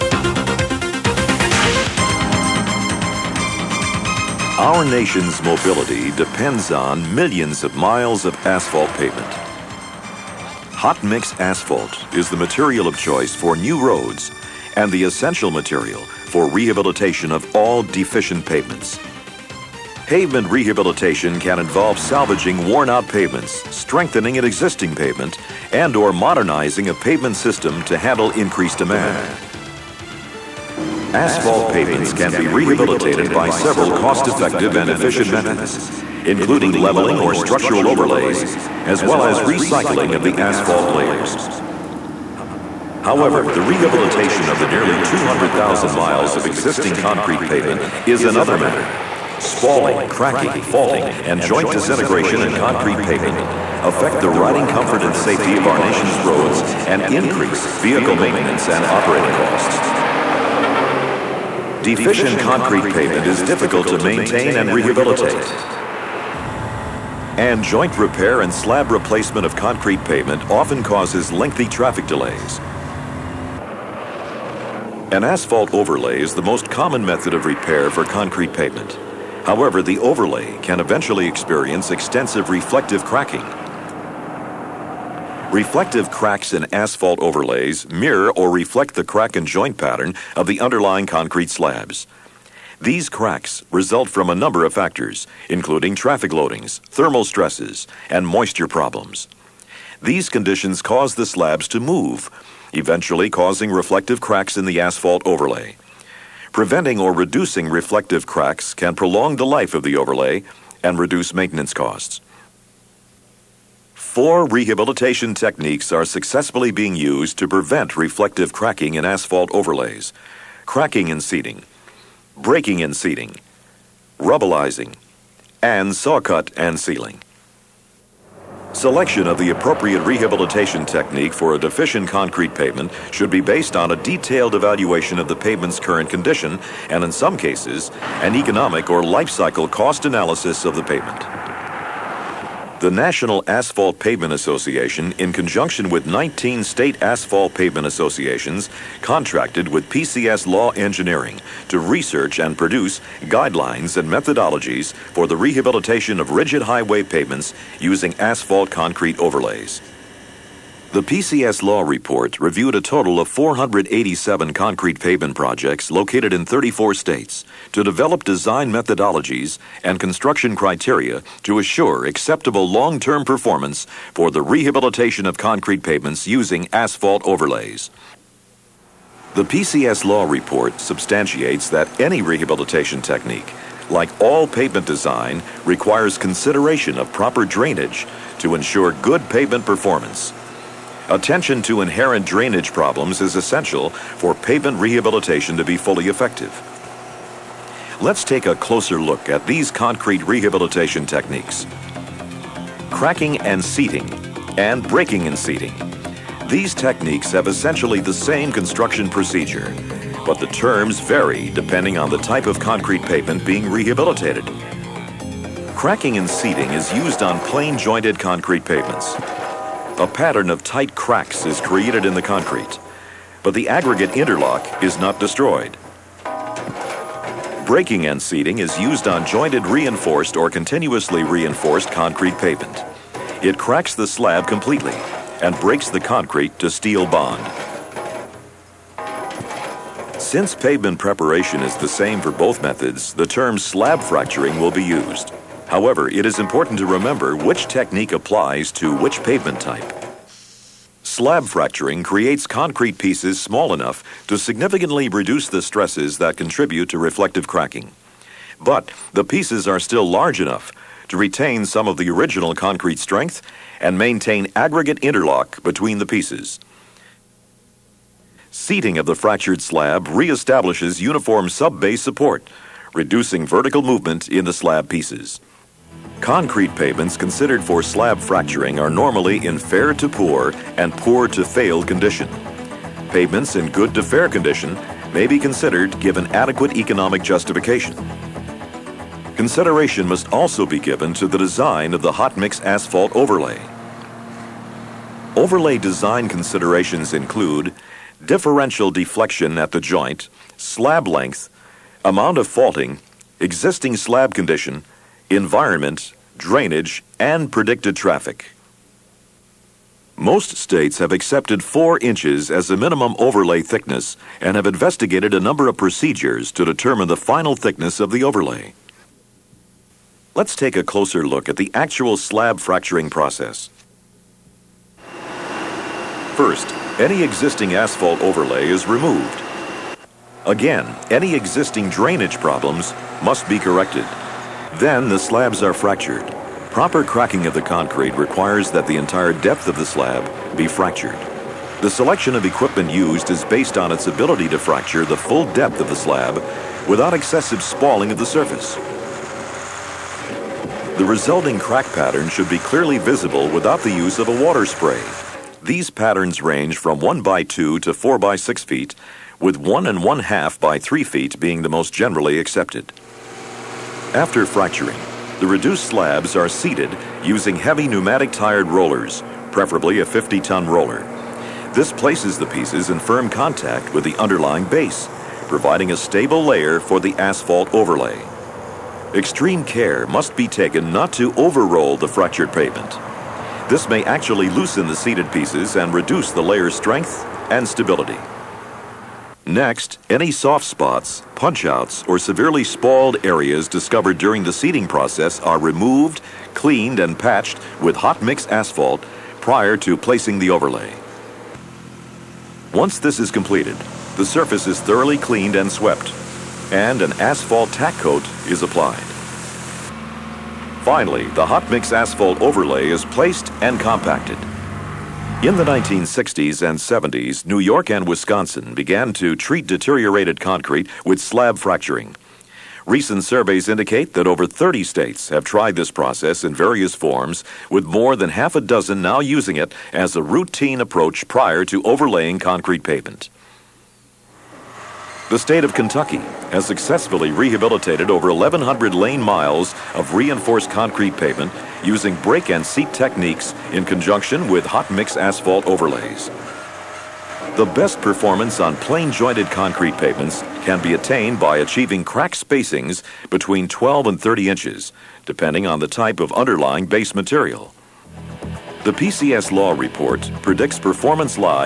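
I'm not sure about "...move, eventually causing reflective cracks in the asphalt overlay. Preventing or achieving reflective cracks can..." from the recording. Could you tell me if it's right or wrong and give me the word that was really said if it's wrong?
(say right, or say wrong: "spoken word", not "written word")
wrong: "reducing", not "achieving".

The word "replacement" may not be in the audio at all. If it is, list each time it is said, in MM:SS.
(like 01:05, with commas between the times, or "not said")
01:08.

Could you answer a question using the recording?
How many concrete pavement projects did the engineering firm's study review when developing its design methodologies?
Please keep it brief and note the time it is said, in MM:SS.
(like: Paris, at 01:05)
487, at 02:43.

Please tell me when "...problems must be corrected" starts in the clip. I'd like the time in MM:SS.
05:32.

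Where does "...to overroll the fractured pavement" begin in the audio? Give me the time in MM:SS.
06:21.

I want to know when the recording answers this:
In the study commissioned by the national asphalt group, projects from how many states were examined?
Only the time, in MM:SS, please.
02:46.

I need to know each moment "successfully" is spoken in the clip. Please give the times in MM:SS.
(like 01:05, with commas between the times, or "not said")
01:56, 07:16.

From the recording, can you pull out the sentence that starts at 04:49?
Consideration must also be given to the design of the hot mix asphalt overlay.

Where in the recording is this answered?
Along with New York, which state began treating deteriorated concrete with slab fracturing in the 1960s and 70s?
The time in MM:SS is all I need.
06:58.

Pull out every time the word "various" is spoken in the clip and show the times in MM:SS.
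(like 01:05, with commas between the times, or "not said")
07:06.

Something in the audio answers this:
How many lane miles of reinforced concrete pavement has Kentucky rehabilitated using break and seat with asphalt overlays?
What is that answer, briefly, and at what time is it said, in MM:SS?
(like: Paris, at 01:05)
1,100, at 07:18.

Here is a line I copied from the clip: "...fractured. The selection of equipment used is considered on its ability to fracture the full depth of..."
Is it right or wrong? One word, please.
wrong.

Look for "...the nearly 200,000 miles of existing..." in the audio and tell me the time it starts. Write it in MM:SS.
00:44.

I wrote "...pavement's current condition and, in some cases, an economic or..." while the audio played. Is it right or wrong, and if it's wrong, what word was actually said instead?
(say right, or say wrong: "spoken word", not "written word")
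right.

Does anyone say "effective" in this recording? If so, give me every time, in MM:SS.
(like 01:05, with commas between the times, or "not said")
00:33, 03:16.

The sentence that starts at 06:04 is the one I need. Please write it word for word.
After fracturing, the reduced slabs are seated using heavy pneumatic tired rollers, preferably a 50-ton roller.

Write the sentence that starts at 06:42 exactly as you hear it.
Once this is completed, the surface is thoroughly cleaned and swept, and an asphalt tack coat is applied.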